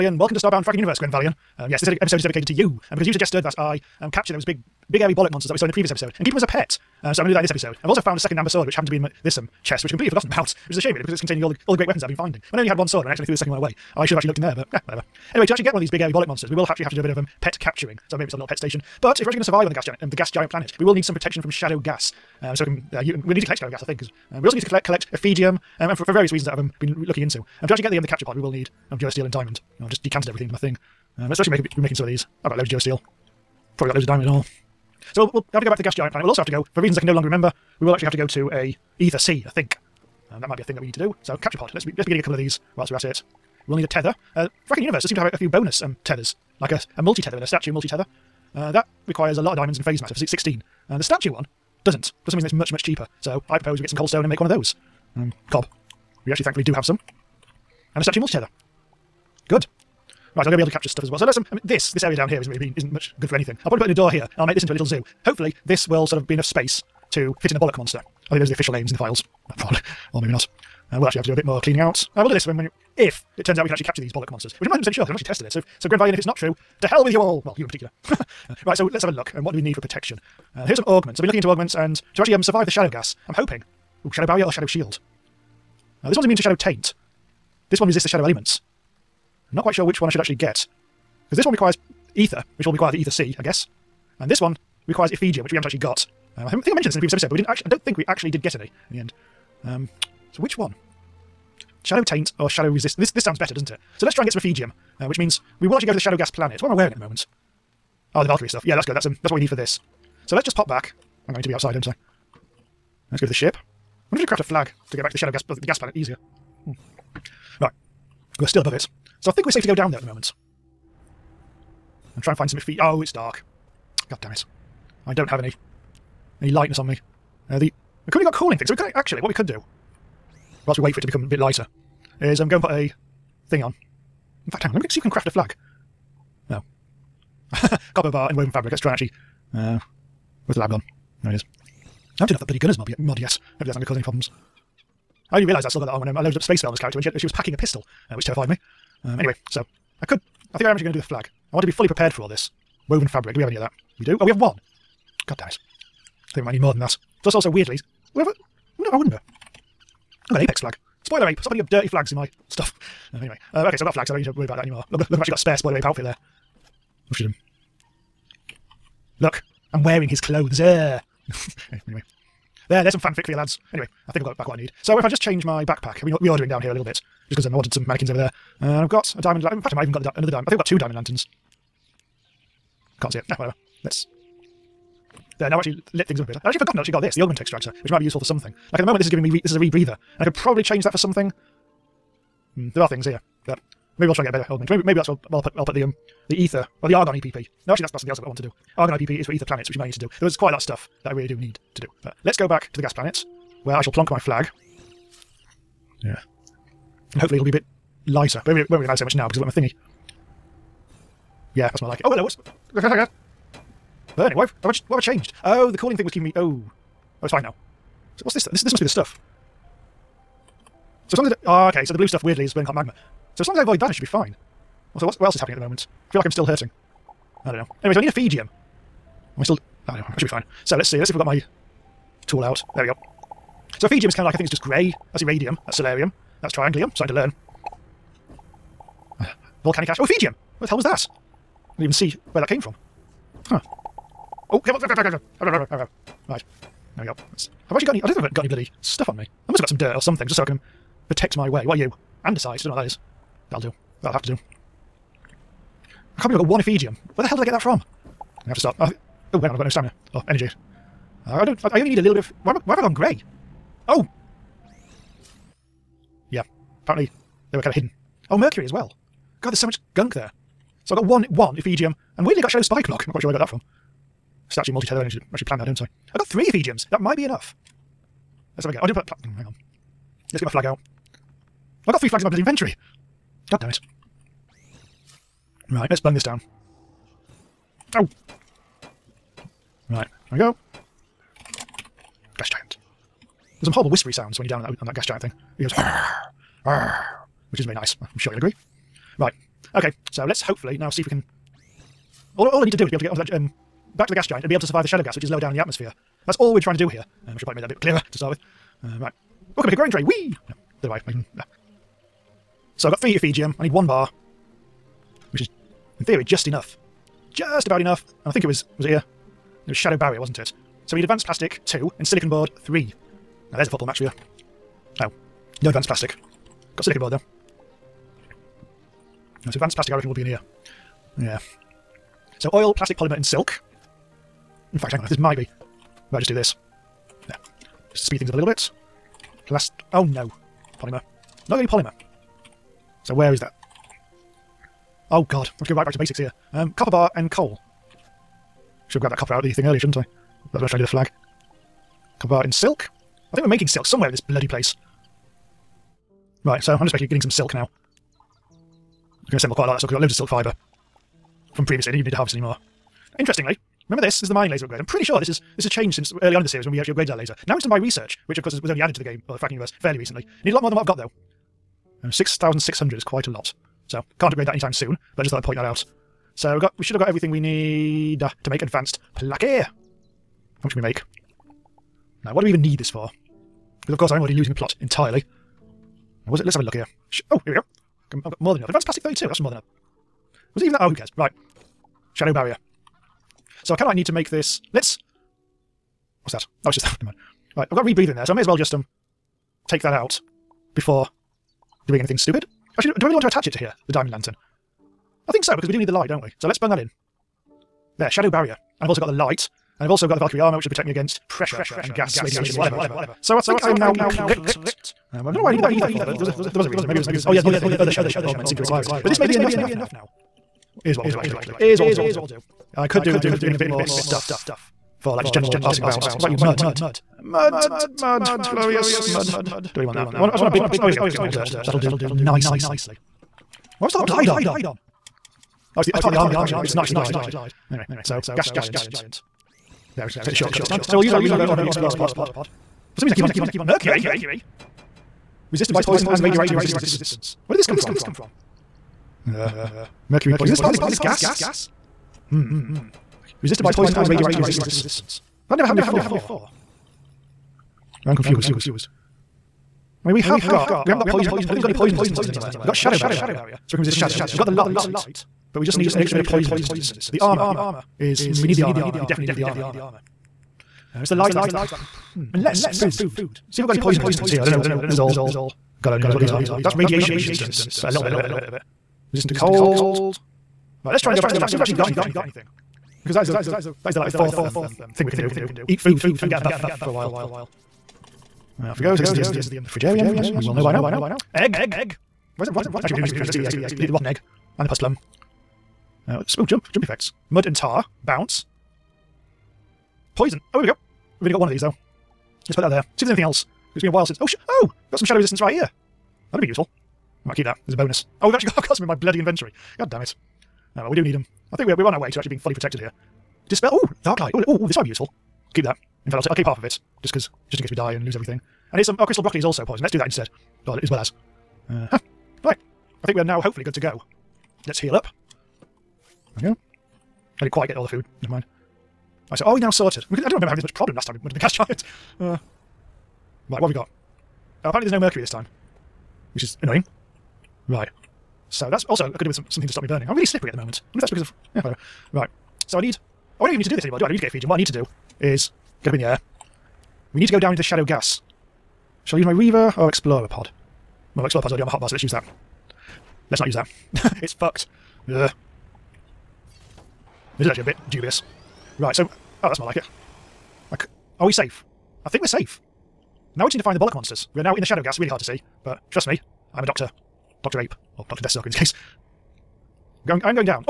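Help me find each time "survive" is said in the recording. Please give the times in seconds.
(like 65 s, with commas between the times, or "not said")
19 s, 82 s, 304 s.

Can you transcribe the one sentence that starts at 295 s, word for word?
It goes, which is not very nice.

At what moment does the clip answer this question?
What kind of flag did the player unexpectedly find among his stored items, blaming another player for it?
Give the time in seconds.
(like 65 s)
160 s.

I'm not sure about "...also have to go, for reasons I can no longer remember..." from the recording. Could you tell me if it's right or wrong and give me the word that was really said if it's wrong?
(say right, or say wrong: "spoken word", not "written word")
right.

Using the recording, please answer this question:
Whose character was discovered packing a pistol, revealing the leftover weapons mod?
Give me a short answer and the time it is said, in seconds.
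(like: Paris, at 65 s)
Space Velma, at 146 s.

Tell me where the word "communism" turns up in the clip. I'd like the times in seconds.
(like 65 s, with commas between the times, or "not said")
not said.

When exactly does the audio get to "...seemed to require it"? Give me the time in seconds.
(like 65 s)
418 s.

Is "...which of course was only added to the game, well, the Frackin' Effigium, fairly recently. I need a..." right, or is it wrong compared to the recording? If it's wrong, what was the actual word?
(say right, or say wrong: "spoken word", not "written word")
wrong: "Universe", not "Effigium".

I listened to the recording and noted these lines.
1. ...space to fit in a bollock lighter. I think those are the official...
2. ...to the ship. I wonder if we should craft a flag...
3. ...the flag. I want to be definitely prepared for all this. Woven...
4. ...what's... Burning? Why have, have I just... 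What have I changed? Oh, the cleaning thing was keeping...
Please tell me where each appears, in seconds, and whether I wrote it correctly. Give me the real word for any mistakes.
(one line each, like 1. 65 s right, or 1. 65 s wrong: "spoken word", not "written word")
1. 66 s wrong: "monster", not "lighter"
2. 113 s right
3. 150 s wrong: "fully", not "definitely"
4. 212 s wrong: "cooling", not "cleaning".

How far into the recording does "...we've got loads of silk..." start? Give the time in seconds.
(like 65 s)
359 s.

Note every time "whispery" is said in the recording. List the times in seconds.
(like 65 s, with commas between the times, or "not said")
293 s.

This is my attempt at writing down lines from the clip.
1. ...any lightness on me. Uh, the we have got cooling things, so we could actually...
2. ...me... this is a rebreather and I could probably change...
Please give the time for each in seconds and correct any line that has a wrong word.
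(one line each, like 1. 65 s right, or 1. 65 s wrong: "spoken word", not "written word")
1. 126 s right
2. 189 s right.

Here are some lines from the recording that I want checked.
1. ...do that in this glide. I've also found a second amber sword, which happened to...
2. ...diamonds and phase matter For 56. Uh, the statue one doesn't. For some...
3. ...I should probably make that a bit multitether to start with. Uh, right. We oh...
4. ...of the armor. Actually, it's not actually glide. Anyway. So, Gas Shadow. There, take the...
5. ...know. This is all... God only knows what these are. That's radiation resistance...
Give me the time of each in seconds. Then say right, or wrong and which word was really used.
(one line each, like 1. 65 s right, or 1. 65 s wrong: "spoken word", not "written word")
1. 7 s wrong: "episode", not "glide"
2. 49 s wrong: "16", not "56"
3. 307 s wrong: "clearer", not "multitether"
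4. 436 s wrong: "Giant", not "Shadow"
5. 474 s right.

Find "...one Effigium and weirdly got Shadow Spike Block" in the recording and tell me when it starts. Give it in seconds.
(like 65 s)
271 s.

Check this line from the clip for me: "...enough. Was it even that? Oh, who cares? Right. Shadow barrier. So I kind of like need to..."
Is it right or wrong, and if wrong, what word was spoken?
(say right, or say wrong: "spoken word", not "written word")
right.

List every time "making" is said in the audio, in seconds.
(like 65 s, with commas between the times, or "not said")
31 s, 353 s.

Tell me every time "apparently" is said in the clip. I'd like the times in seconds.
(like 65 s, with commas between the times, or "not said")
266 s, 534 s.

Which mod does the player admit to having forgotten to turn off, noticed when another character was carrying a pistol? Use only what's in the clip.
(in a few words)
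Gunners mod.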